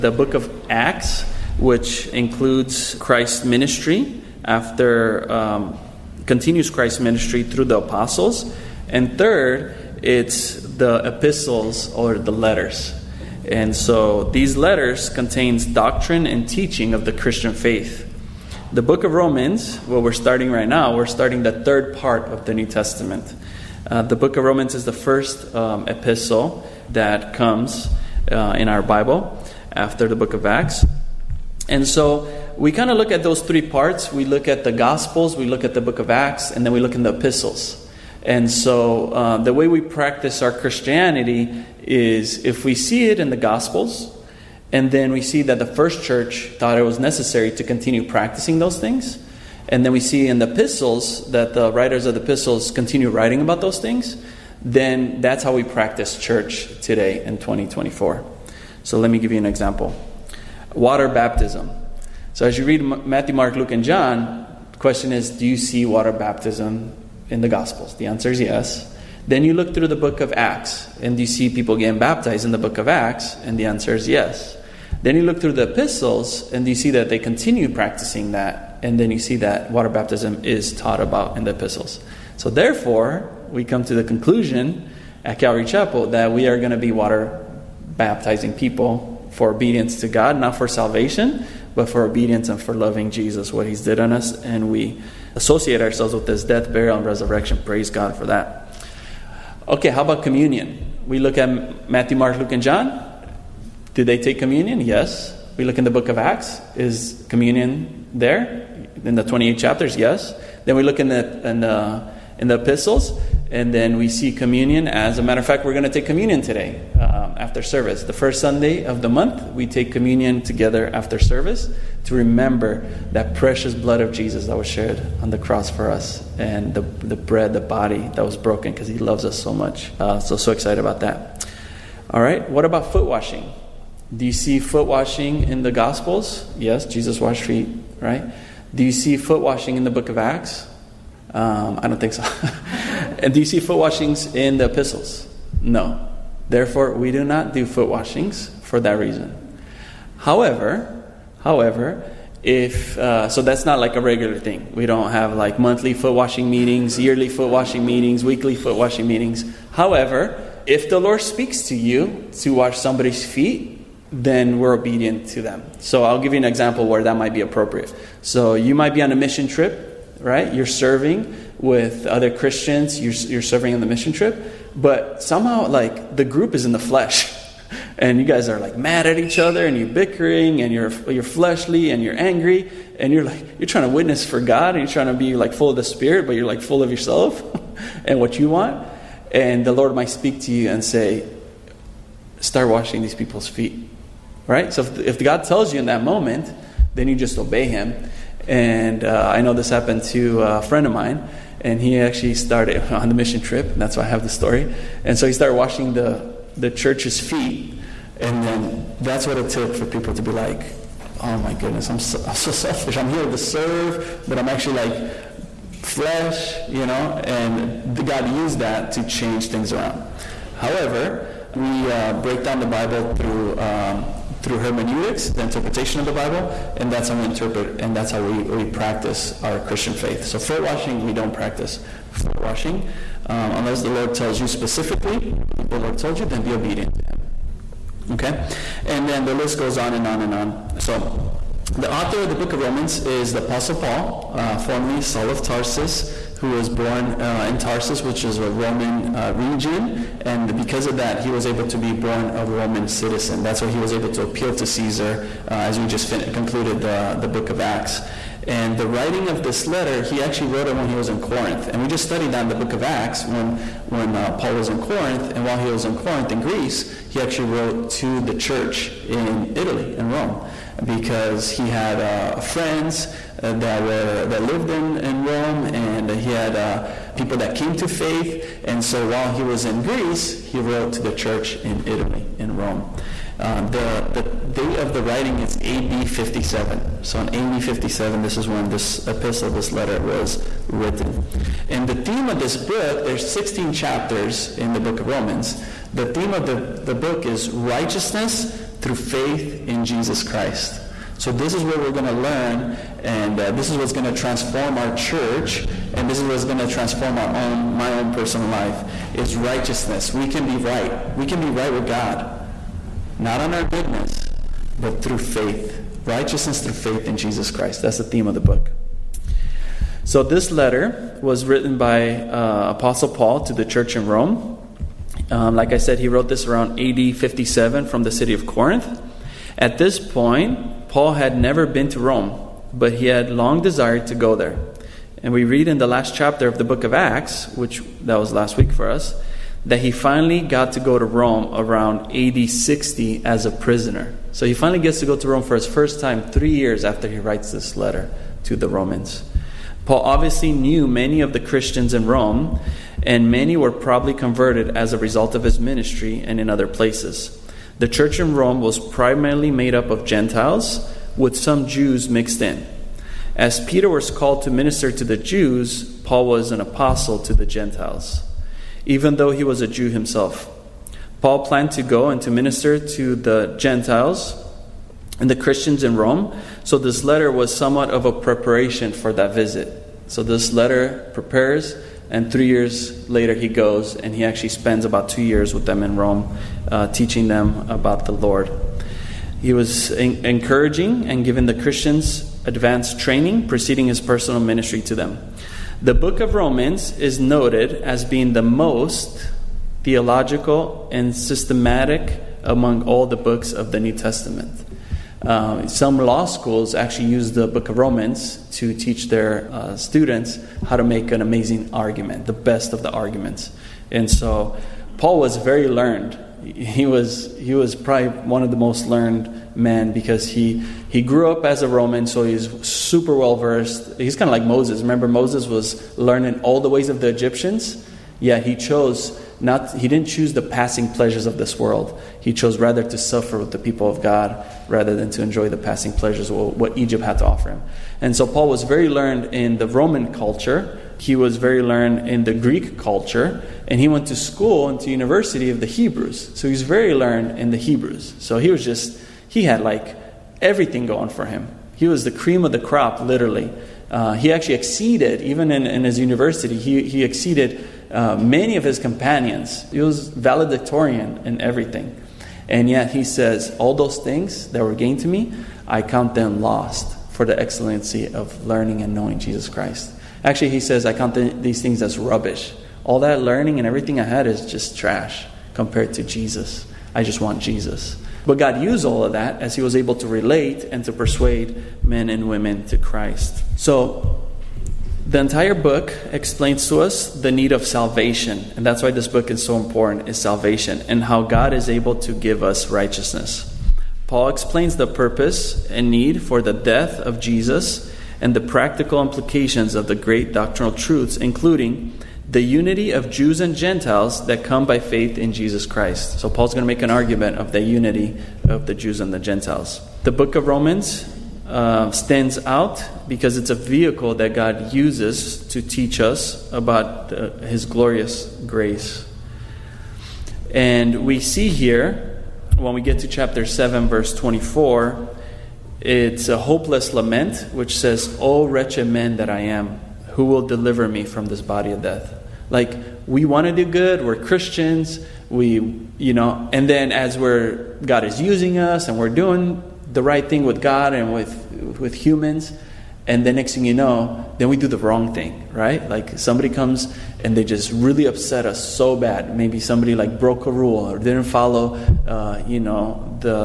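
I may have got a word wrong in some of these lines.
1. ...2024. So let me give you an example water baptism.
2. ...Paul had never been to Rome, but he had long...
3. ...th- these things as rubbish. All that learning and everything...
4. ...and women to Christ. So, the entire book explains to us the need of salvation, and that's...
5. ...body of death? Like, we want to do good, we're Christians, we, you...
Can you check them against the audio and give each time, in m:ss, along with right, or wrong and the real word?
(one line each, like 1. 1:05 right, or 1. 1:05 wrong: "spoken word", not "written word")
1. 0:57 right
2. 5:30 right
3. 7:51 right
4. 8:02 right
5. 8:51 right.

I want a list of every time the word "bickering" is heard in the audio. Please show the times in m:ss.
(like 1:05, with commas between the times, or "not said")
2:59.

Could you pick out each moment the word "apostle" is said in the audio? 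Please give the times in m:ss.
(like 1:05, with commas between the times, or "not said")
0:07, 4:03, 5:22, 6:06.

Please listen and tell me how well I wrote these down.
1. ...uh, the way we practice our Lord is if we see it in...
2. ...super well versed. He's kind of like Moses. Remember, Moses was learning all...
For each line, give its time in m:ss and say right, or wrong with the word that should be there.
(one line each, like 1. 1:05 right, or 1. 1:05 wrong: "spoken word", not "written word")
1. 0:39 wrong: "Christianity", not "Lord"
2. 7:02 right.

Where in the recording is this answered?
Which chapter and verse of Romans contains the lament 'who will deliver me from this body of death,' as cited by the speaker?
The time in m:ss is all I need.
8:43.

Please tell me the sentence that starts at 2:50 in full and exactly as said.
You're serving with other Christians, you're, you're serving on the mission trip, but somehow, like, the group is in the flesh.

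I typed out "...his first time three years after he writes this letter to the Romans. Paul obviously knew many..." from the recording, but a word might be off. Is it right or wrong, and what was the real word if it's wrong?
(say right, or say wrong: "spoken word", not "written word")
right.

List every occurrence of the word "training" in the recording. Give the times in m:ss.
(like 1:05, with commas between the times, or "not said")
6:32.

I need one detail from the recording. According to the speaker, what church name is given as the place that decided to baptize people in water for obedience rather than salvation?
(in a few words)
Calvary Chapel.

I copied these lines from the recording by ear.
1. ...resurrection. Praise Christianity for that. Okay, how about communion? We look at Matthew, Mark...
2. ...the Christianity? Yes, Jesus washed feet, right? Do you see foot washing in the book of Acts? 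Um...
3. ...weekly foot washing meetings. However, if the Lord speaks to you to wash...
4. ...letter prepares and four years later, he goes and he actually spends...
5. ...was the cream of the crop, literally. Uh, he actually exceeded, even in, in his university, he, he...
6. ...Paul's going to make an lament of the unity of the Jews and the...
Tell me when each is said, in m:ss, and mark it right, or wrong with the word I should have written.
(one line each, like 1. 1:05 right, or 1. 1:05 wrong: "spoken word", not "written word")
1. 1:37 wrong: "God", not "Christianity"
2. 2:15 wrong: "Gospels", not "Christianity"
3. 2:38 right
4. 6:20 wrong: "three", not "four"
5. 7:31 right
6. 8:26 wrong: "argument", not "lament".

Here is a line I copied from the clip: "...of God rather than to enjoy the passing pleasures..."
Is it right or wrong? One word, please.
right.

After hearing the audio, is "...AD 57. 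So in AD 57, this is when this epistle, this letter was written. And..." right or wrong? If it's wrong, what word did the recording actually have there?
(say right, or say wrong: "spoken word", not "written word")
right.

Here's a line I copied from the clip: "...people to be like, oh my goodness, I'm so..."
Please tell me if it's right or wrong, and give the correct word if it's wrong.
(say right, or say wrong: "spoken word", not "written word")
right.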